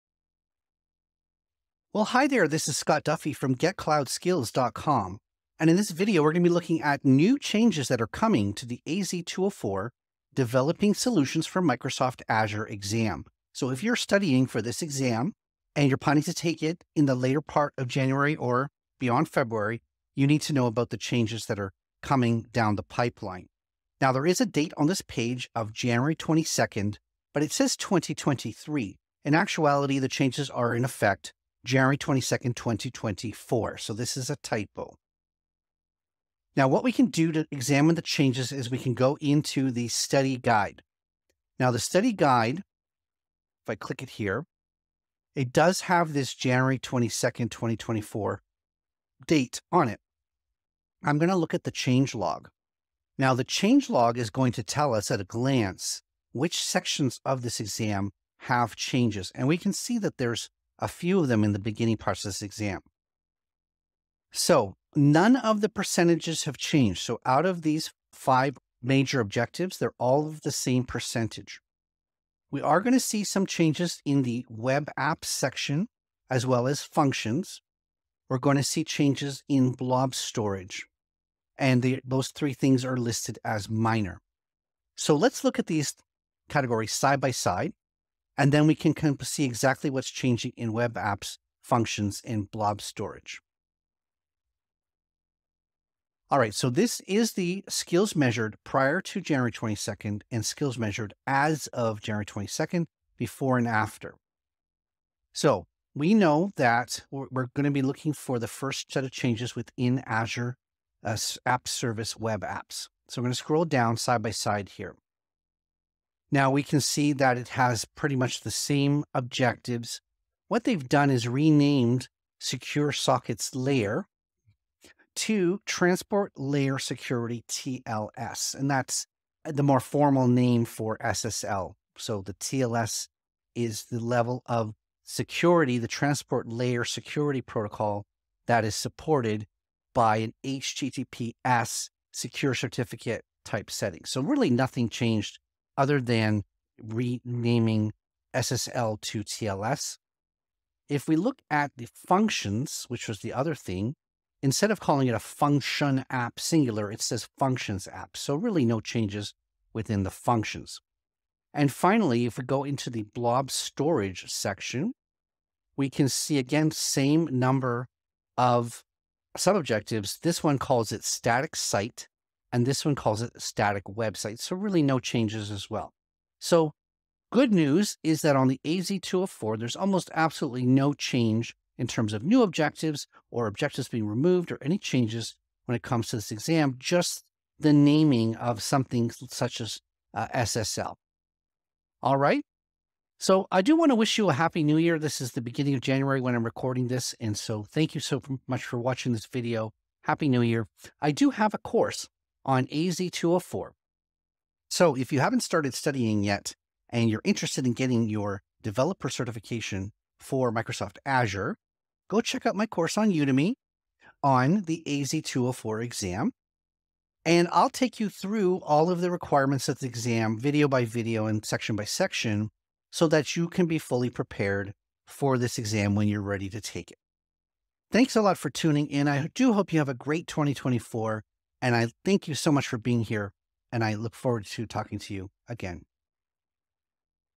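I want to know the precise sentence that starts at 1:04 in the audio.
So none of the percentages have changed.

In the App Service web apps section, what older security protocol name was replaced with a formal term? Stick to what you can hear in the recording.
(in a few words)
Secure sockets layer.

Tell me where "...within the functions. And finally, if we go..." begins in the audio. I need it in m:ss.
2:39.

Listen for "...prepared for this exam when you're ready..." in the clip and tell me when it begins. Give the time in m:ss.
3:44.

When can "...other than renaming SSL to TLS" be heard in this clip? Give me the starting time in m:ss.
2:25.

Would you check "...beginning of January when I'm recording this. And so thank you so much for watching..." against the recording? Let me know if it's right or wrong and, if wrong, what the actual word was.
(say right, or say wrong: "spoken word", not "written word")
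right.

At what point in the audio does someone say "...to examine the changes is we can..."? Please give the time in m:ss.
0:37.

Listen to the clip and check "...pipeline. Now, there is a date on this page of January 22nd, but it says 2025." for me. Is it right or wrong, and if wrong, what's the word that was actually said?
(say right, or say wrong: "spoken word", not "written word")
wrong: "2023", not "2025".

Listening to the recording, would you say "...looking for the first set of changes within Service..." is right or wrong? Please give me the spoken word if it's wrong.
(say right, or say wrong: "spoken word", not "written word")
wrong: "Azure", not "Service".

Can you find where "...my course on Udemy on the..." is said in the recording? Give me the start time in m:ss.
3:32.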